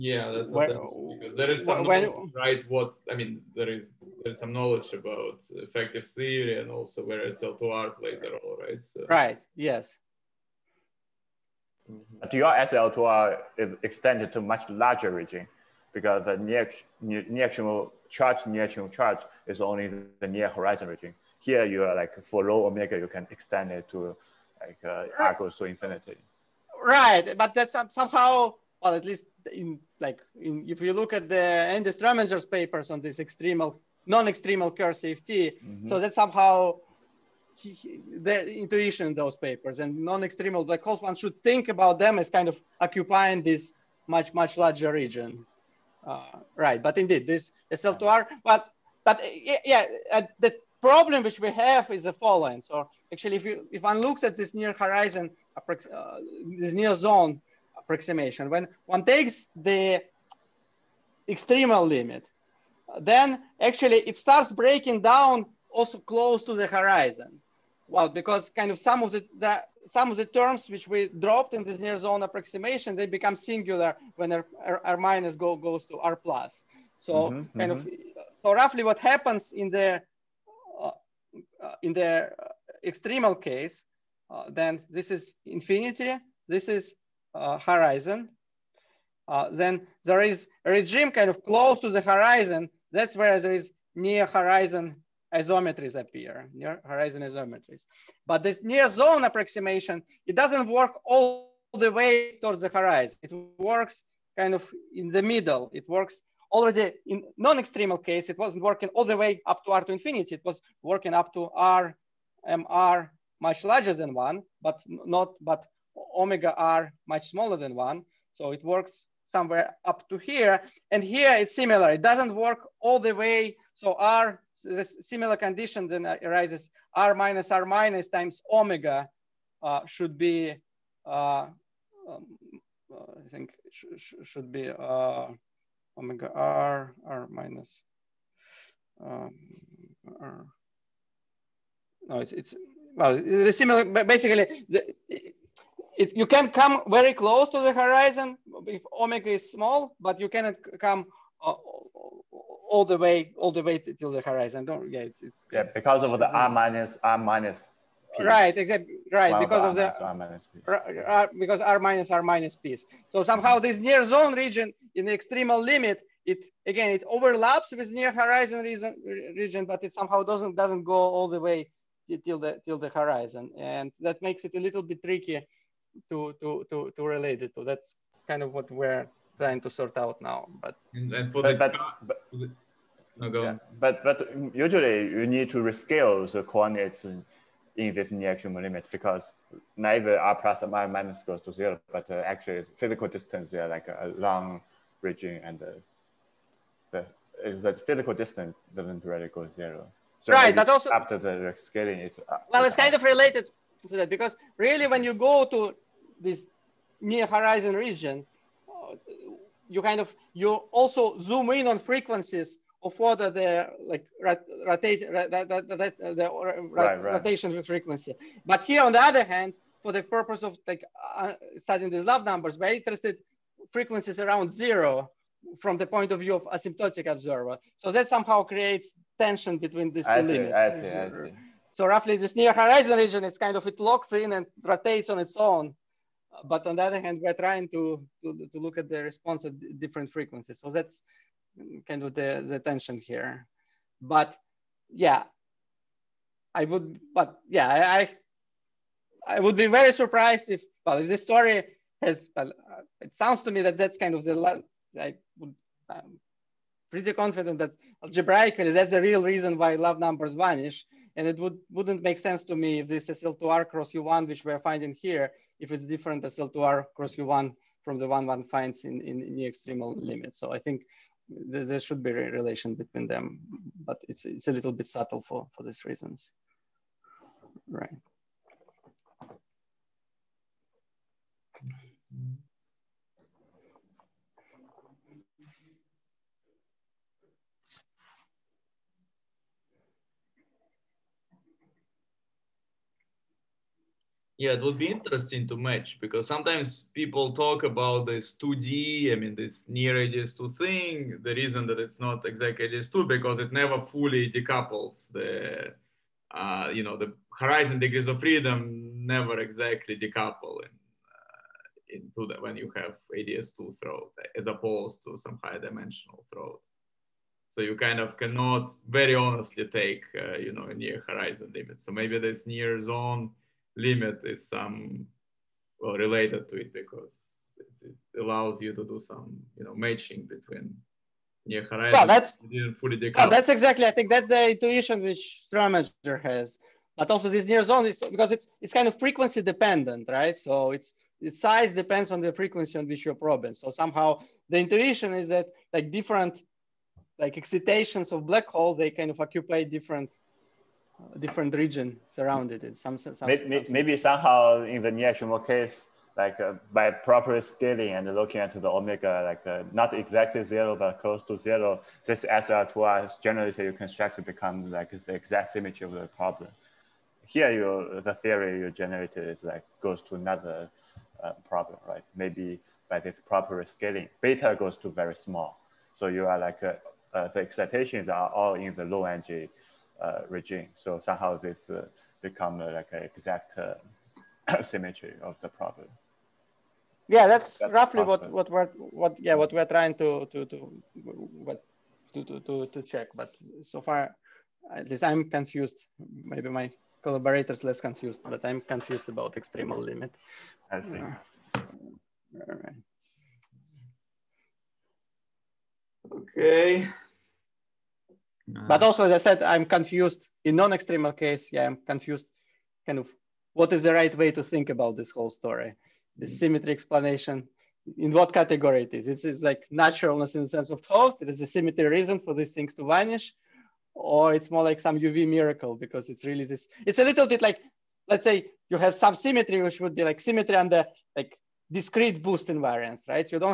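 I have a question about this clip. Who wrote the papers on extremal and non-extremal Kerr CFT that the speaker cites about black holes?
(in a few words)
Andy Strominger.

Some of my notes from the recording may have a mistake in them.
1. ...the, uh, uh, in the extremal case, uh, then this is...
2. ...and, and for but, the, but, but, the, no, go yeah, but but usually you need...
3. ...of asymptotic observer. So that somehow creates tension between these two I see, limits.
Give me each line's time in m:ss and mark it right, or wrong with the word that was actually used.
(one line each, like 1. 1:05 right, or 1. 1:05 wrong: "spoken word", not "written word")
1. 1:19 right
2. 3:00 right
3. 3:46 right.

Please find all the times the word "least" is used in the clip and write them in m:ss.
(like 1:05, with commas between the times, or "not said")
0:29, 6:34.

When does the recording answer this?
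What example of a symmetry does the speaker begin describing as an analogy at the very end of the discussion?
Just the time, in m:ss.
7:11.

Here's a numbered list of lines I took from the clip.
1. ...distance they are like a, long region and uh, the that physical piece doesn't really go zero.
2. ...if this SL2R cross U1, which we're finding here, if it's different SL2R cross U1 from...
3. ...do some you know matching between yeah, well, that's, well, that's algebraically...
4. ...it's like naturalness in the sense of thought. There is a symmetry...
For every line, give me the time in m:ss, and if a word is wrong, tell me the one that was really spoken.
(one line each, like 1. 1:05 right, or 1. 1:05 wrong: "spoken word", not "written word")
1. 3:13 wrong: "distance", not "piece"
2. 4:22 right
3. 5:28 wrong: "exactly", not "algebraically"
4. 6:59 right.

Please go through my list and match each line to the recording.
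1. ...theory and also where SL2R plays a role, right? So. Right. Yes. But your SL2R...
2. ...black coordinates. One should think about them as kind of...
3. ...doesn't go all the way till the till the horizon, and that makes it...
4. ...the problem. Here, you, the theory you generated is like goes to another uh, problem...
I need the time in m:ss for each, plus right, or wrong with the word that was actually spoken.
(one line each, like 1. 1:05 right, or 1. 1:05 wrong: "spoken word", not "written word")
1. 0:06 right
2. 0:40 wrong: "holes", not "coordinates"
3. 2:50 right
4. 6:05 right.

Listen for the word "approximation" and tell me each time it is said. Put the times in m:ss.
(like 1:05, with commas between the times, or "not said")
0:57, 1:12, 1:39.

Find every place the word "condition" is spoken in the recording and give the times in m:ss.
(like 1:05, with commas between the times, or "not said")
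2:05.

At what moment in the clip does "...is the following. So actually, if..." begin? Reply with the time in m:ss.
0:51.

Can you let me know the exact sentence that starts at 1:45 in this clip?
It works already in non-extremal case, it wasn't working all the way up to R to infinity.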